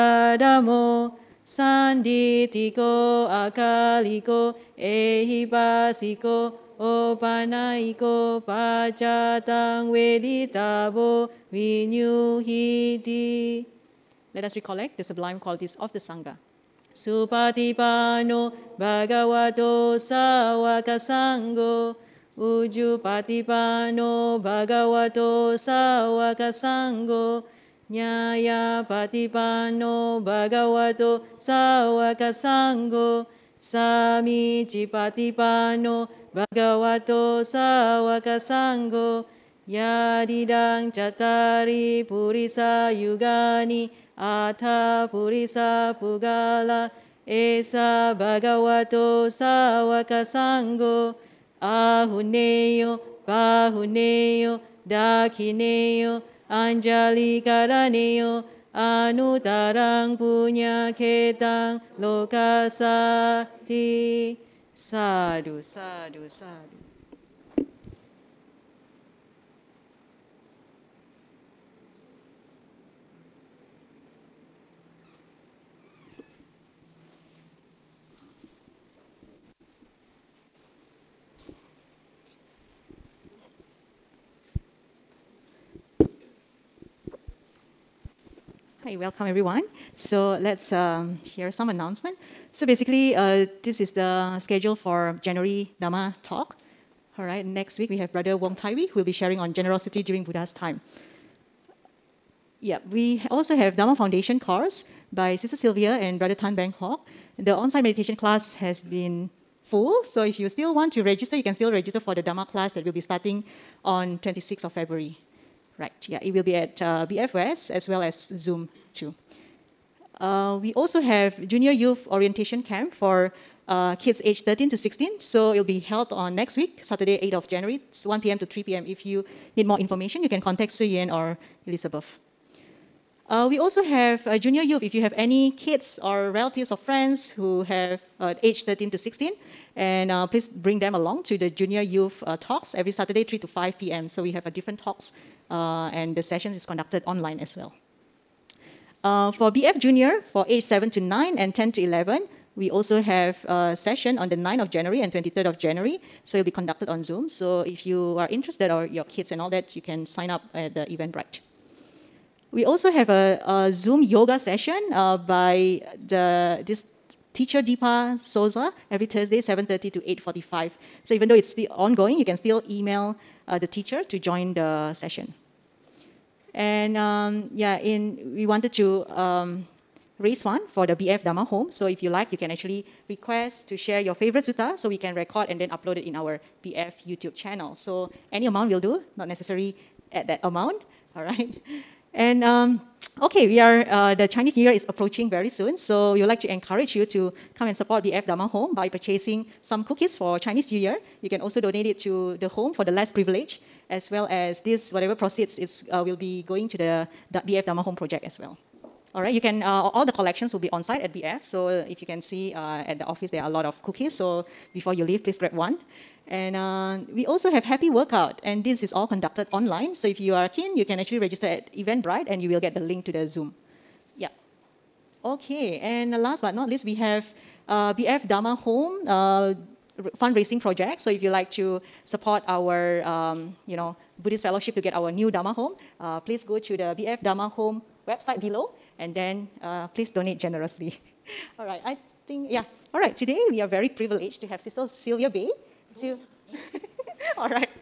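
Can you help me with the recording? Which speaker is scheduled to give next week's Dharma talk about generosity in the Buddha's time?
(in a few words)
Wong Tai Wei.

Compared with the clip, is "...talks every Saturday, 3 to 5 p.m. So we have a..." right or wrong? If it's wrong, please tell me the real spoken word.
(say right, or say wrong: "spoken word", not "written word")
right.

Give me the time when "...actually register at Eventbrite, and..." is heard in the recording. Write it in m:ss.
3:40.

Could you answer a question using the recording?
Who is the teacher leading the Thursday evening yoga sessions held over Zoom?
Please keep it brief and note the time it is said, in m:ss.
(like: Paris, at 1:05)
Deepa Souza, at 2:47.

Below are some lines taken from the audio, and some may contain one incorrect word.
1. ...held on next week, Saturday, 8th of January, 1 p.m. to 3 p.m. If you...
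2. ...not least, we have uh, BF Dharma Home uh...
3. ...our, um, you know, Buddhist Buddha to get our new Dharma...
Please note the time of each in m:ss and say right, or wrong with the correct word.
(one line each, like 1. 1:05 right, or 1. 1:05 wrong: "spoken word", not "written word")
1. 2:05 right
2. 3:46 right
3. 3:52 wrong: "Fellowship", not "Buddha".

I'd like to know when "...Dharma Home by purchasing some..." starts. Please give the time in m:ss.
3:18.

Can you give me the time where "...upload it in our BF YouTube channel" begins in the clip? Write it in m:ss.
3:05.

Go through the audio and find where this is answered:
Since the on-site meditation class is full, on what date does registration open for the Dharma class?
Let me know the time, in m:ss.
1:54.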